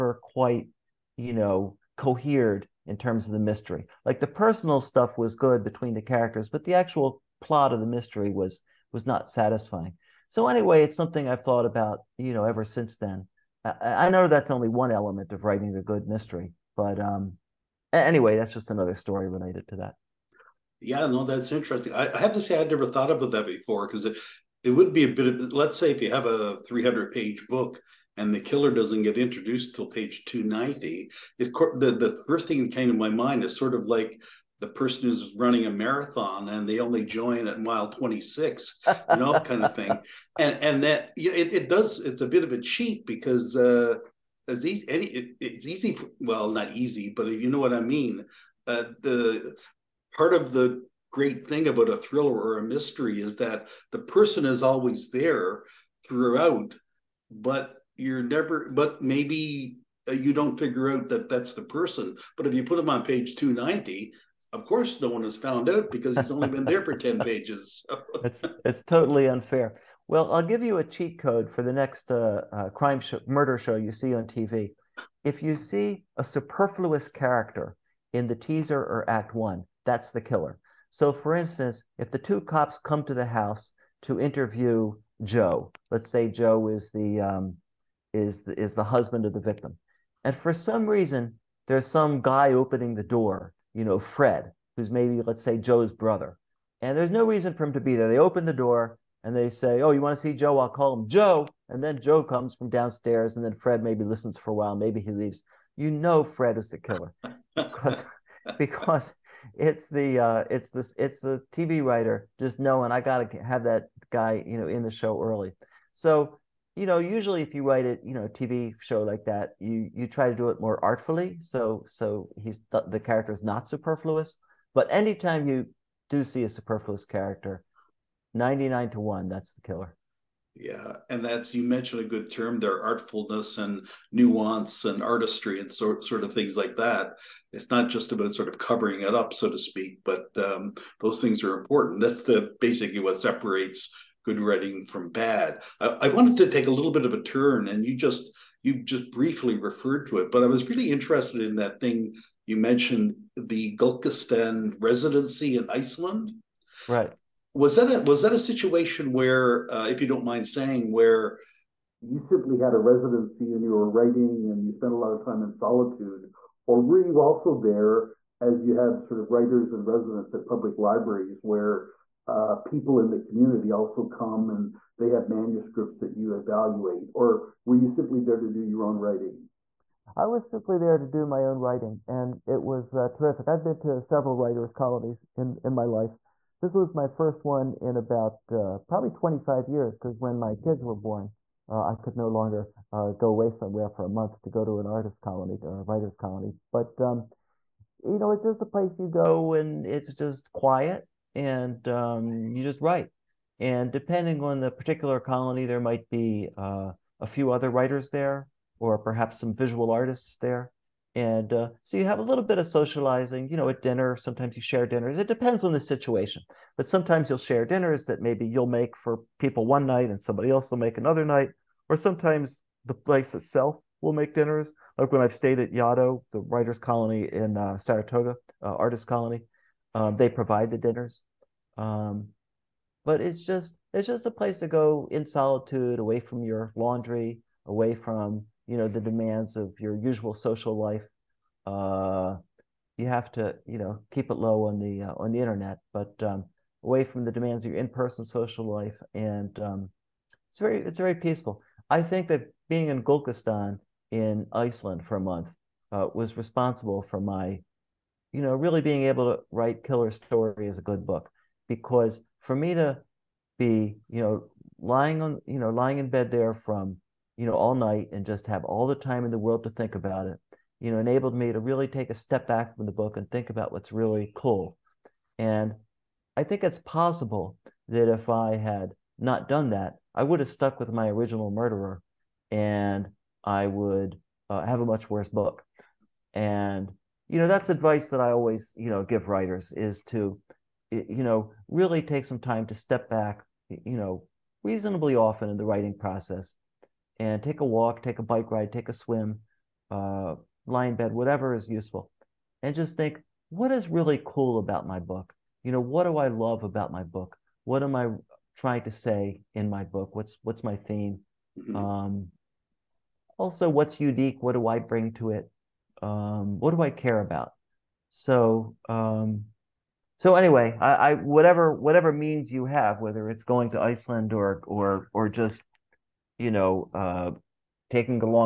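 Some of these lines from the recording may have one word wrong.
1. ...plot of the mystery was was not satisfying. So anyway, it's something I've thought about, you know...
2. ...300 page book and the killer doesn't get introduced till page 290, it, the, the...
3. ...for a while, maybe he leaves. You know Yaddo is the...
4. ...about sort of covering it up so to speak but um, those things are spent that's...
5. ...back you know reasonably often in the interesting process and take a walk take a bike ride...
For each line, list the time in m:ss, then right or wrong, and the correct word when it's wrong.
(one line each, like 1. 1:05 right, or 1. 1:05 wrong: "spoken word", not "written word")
1. 0:07 right
2. 0:26 right
3. 1:44 wrong: "Fred", not "Yaddo"
4. 2:18 wrong: "important", not "spent"
5. 4:53 wrong: "writing", not "interesting".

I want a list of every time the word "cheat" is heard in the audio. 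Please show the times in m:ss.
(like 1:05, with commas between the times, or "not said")
0:42, 1:10.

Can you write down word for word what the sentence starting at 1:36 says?
And there's no reason for him to be there.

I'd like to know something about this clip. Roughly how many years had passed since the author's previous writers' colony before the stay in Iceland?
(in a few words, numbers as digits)
25.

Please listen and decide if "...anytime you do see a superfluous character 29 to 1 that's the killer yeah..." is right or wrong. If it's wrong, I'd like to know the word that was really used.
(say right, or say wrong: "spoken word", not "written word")
wrong: "99", not "29".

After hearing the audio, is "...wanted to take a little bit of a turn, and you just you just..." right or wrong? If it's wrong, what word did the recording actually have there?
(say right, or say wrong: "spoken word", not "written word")
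right.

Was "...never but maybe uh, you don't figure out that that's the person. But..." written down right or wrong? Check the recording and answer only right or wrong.
right.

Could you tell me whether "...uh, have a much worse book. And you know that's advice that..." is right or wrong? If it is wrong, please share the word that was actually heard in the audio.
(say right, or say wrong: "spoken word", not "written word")
right.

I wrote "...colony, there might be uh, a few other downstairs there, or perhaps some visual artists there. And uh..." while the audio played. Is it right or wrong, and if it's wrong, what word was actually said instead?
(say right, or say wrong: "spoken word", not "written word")
wrong: "writers", not "downstairs".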